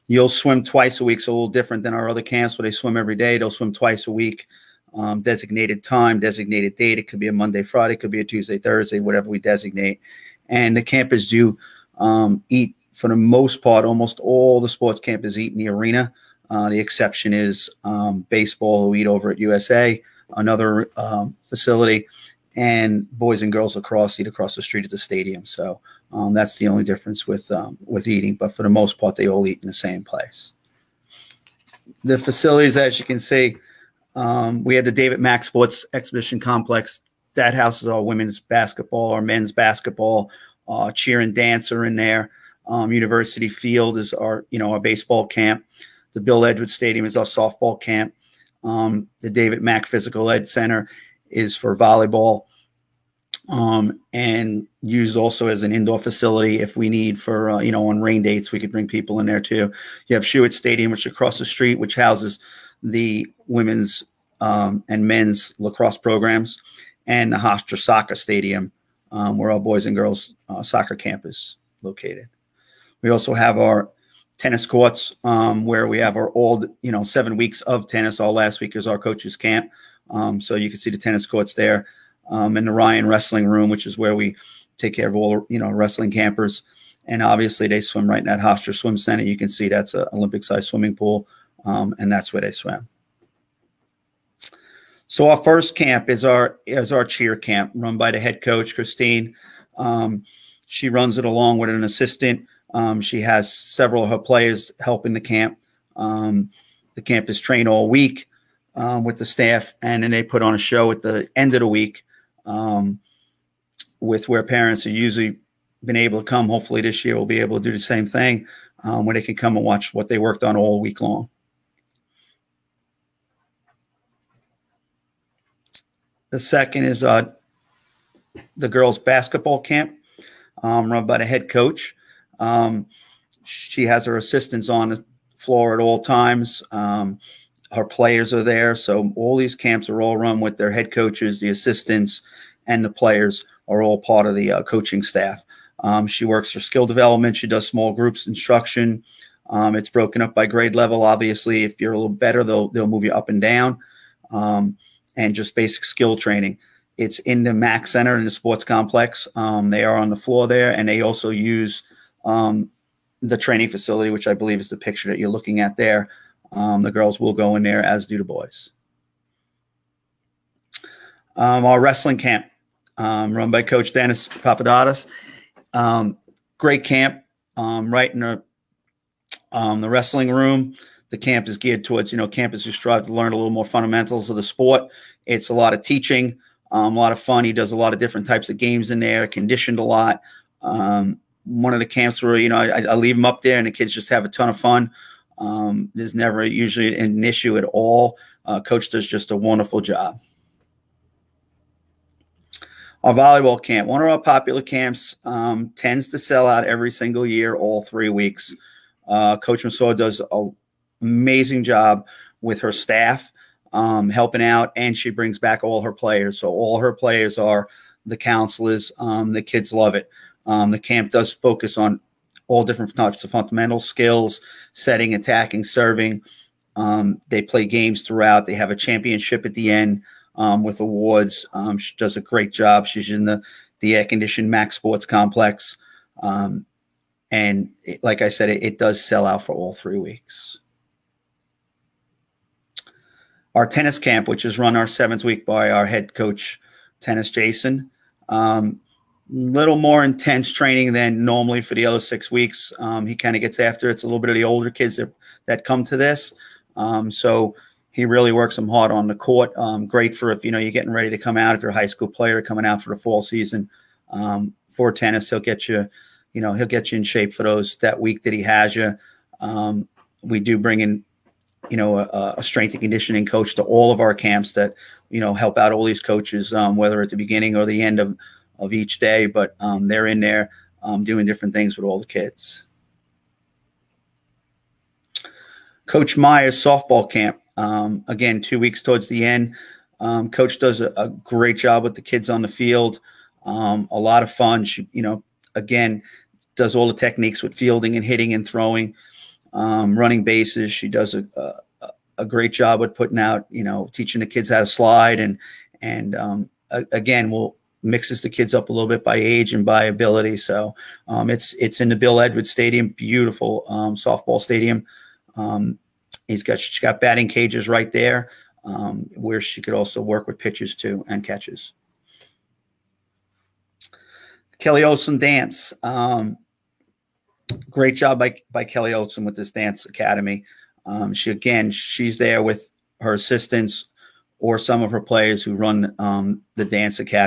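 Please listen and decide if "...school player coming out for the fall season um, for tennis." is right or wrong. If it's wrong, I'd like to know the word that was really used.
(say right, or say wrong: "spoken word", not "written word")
right.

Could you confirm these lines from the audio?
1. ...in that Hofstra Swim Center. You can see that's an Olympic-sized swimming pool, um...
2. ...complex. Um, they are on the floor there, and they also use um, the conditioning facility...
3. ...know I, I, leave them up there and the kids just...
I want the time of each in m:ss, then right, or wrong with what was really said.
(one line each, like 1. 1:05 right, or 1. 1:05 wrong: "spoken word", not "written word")
1. 1:28 right
2. 2:38 wrong: "training", not "conditioning"
3. 3:12 right.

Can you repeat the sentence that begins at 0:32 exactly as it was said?
The facilities, as you can see, um, we had the David Mack Sports Exhibition Complex.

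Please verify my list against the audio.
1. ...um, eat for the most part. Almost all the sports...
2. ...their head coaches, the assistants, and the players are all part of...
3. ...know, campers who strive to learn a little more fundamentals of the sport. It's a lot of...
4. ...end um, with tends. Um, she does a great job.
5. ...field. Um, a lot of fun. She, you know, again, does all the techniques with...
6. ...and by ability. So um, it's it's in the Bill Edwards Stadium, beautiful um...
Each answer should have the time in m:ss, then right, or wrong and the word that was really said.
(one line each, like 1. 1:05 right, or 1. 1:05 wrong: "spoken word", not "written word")
1. 0:11 right
2. 2:20 right
3. 3:02 right
4. 3:49 wrong: "awards", not "tends"
5. 4:52 right
6. 5:09 right.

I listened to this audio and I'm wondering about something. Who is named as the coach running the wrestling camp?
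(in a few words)
Dennis Papadakis.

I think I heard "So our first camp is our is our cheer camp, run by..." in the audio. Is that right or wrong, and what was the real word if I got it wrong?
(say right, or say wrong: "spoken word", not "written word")
right.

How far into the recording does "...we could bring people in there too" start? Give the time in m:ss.
0:58.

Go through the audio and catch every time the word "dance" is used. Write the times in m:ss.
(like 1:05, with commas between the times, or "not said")
0:41, 5:25, 5:29, 5:36.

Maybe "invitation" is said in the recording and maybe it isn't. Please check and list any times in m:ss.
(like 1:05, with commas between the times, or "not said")
not said.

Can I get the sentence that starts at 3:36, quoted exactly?
So all her players are the counselors.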